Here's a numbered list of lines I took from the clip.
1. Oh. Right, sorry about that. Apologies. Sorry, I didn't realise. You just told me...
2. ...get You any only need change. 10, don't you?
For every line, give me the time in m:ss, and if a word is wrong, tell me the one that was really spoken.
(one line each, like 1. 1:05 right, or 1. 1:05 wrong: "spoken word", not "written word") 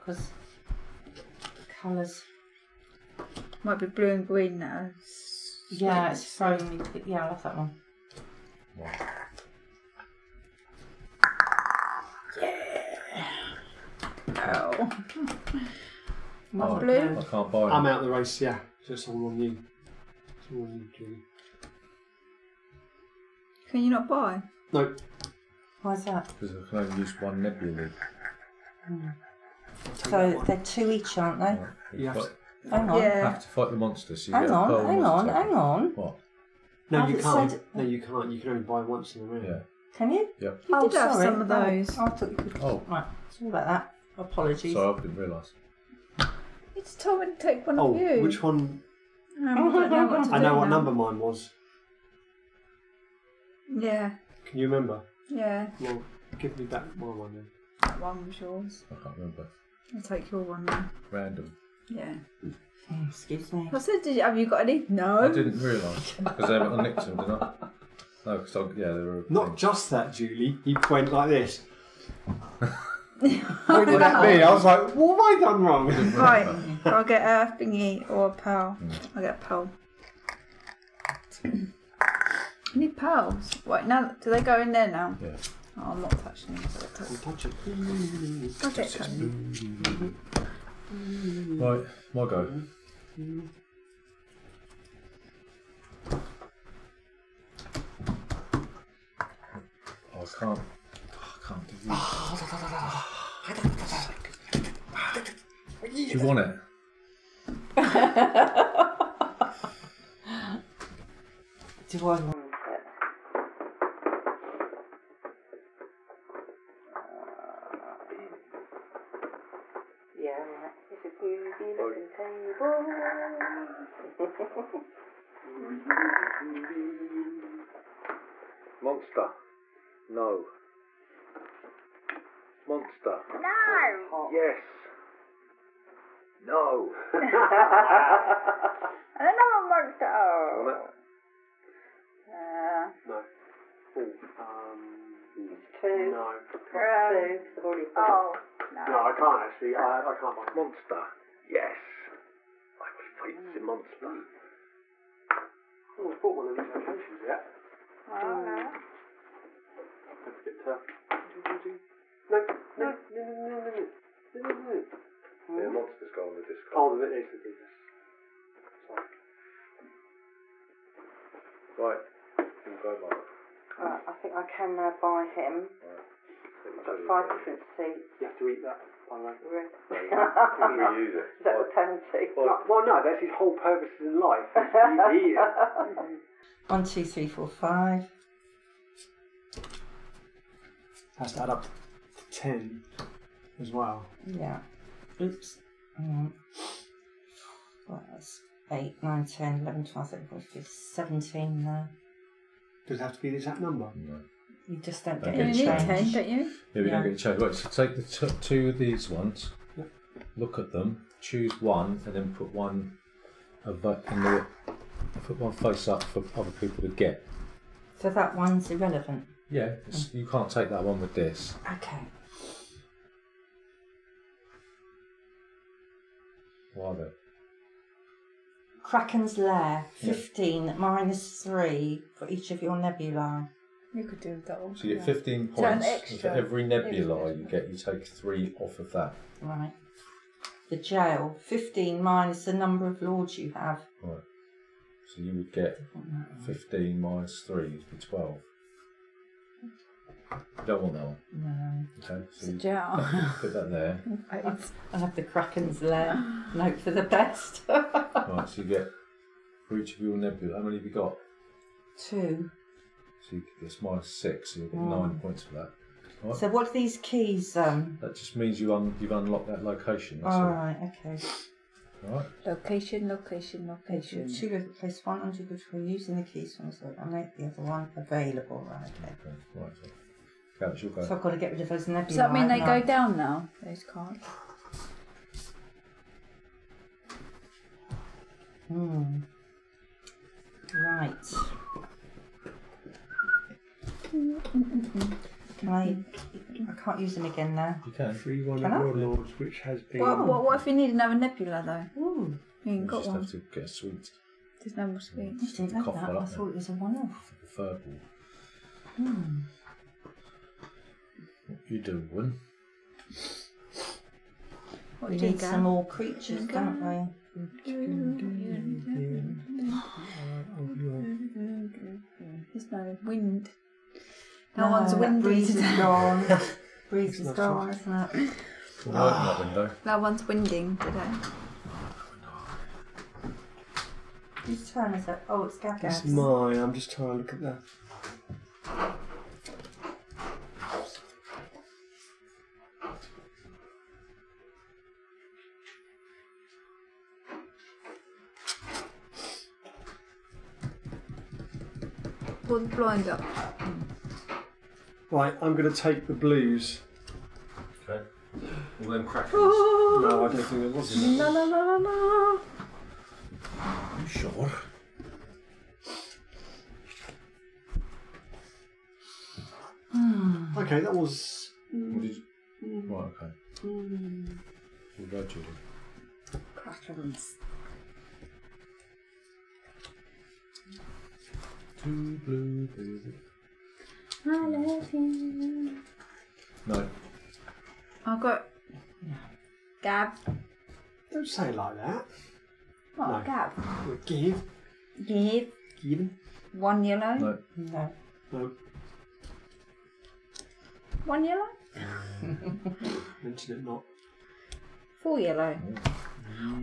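1. 0:42 right
2. 3:25 right.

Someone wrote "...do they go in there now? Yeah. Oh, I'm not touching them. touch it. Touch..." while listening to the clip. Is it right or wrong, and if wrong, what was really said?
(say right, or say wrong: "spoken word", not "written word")
right.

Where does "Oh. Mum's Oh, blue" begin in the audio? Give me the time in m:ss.
0:14.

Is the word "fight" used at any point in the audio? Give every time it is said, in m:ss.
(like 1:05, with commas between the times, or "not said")
0:33, 2:33.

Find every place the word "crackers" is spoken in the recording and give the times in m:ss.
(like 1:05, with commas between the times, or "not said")
5:59, 6:16.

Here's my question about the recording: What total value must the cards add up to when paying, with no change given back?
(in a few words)
10.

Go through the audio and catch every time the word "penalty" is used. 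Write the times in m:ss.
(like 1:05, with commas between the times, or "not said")
3:01.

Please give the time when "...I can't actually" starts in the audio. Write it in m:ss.
2:28.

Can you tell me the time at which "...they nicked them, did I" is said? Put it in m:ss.
1:06.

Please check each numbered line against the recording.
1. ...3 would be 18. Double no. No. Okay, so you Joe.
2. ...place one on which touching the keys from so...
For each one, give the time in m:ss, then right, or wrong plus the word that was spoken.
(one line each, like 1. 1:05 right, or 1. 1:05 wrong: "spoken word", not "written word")
1. 4:07 wrong: "12", not "18"
2. 4:34 wrong: "using", not "touching".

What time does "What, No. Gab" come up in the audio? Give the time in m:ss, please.
6:32.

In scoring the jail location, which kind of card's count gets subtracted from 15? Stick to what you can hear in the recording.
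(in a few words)
lords.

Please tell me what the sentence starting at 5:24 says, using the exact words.
No, one's that windy breeze is gone.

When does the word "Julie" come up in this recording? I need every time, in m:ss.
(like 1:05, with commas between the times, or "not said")
1:10.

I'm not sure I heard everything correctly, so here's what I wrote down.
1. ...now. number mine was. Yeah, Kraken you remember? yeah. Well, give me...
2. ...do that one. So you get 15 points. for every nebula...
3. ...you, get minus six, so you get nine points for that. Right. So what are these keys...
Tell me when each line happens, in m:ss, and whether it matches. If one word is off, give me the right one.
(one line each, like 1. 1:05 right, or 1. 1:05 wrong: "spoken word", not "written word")
1. 0:50 wrong: "Can", not "Kraken"
2. 3:54 right
3. 4:23 right.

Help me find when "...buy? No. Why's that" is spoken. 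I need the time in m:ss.
0:24.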